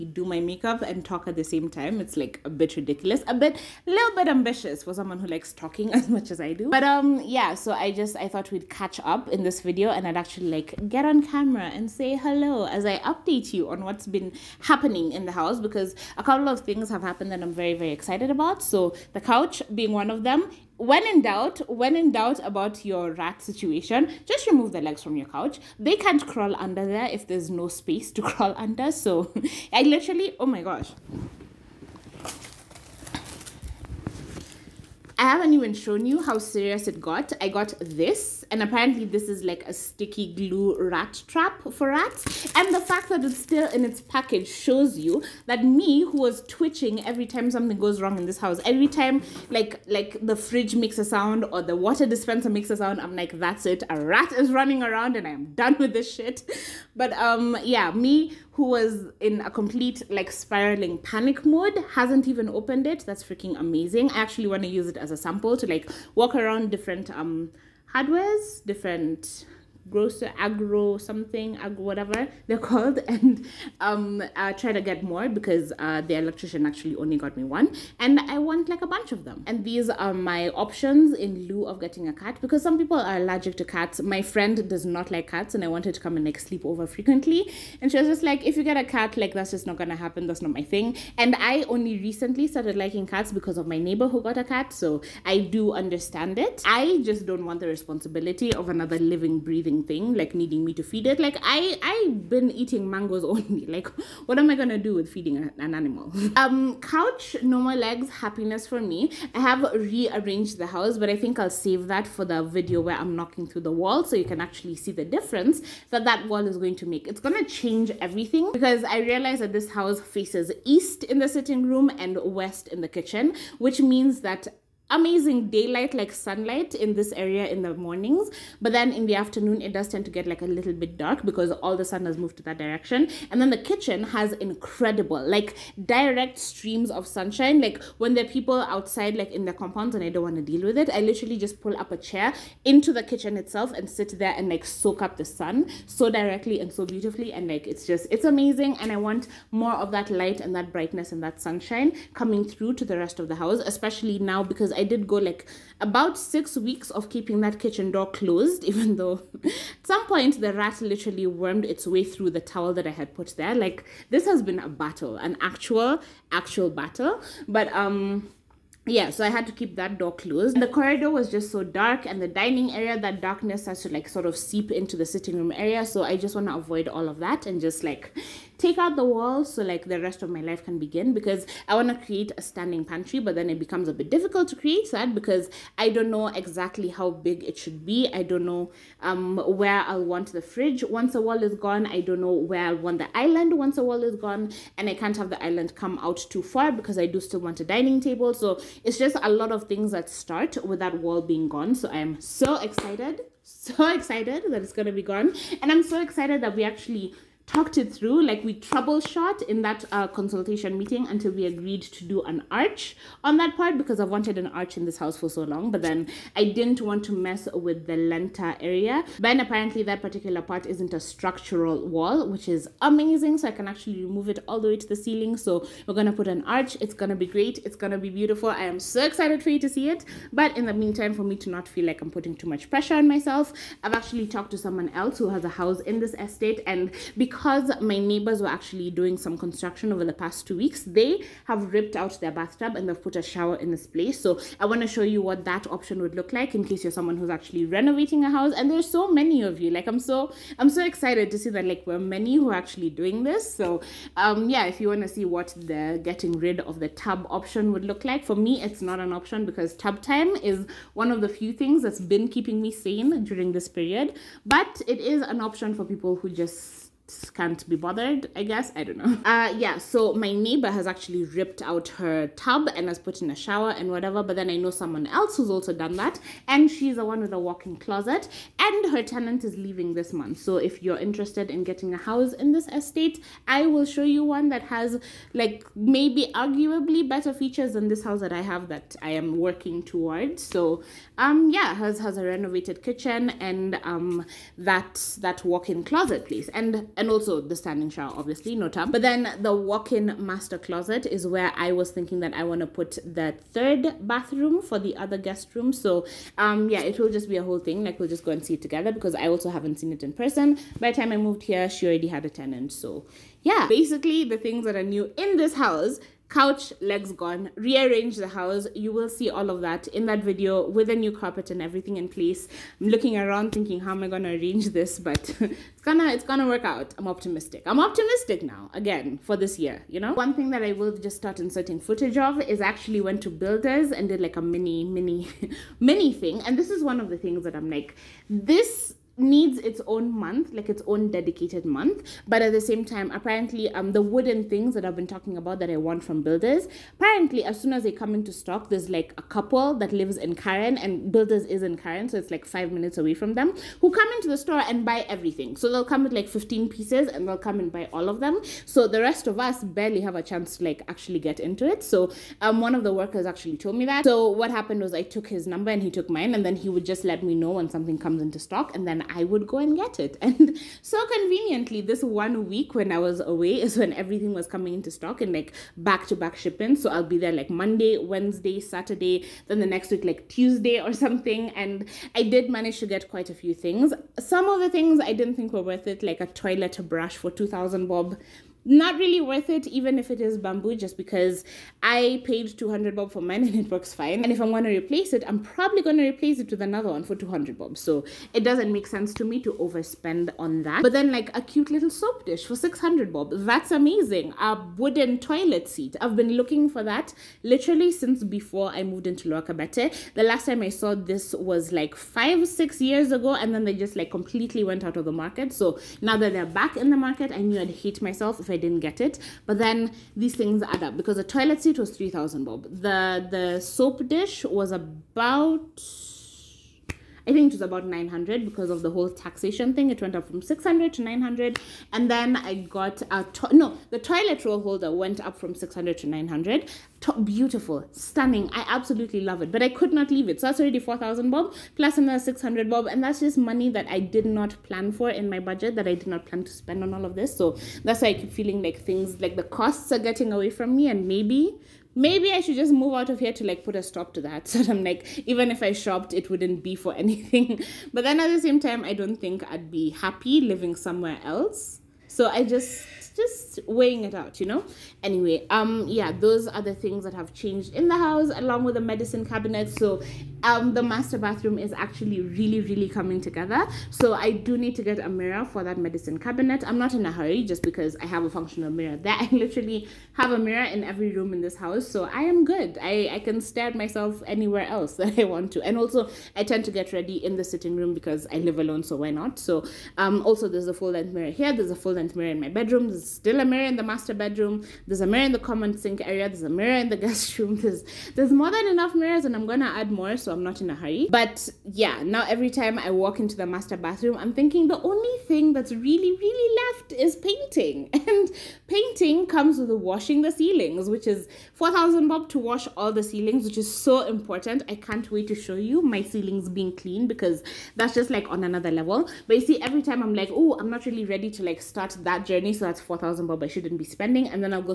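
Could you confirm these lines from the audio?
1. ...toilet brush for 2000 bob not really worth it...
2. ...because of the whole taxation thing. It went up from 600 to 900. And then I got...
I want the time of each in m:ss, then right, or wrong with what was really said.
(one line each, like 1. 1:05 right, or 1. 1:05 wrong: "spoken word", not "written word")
1. 6:26 right
2. 7:08 right.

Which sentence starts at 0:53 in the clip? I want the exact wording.
A rat is running around and I'm done with this shit.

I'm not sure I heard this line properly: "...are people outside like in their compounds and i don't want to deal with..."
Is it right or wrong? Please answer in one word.
right.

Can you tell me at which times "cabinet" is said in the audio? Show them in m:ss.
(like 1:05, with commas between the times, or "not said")
7:49, 7:56.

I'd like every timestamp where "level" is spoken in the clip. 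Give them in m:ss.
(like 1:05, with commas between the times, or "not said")
8:38.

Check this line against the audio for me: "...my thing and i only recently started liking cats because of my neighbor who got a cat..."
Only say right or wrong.
right.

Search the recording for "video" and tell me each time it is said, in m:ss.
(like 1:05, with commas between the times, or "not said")
0:09, 1:52, 5:20.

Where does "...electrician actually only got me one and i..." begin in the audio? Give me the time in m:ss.
1:16.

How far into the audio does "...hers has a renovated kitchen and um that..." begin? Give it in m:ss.
4:51.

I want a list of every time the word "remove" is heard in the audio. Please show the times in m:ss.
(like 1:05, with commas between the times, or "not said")
0:24, 3:44.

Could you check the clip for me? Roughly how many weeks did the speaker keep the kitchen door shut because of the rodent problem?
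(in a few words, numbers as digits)
6 weeks.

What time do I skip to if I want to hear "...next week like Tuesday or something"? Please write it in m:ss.
6:19.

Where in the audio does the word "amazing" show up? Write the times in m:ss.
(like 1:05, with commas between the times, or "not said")
1:03, 2:04, 2:28, 3:42, 6:43.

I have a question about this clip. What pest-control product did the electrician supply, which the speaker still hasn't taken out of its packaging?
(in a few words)
sticky glue rat trap.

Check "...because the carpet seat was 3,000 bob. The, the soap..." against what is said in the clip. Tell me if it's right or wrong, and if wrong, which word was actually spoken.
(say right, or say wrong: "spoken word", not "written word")
wrong: "toilet", not "carpet".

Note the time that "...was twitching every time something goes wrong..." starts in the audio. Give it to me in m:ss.
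0:46.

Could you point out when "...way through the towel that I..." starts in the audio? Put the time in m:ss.
2:41.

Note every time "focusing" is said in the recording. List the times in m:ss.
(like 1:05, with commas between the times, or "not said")
not said.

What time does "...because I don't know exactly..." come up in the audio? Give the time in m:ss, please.
3:05.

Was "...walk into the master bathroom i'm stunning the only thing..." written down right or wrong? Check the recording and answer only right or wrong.
wrong.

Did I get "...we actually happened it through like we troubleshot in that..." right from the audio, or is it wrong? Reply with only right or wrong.
wrong.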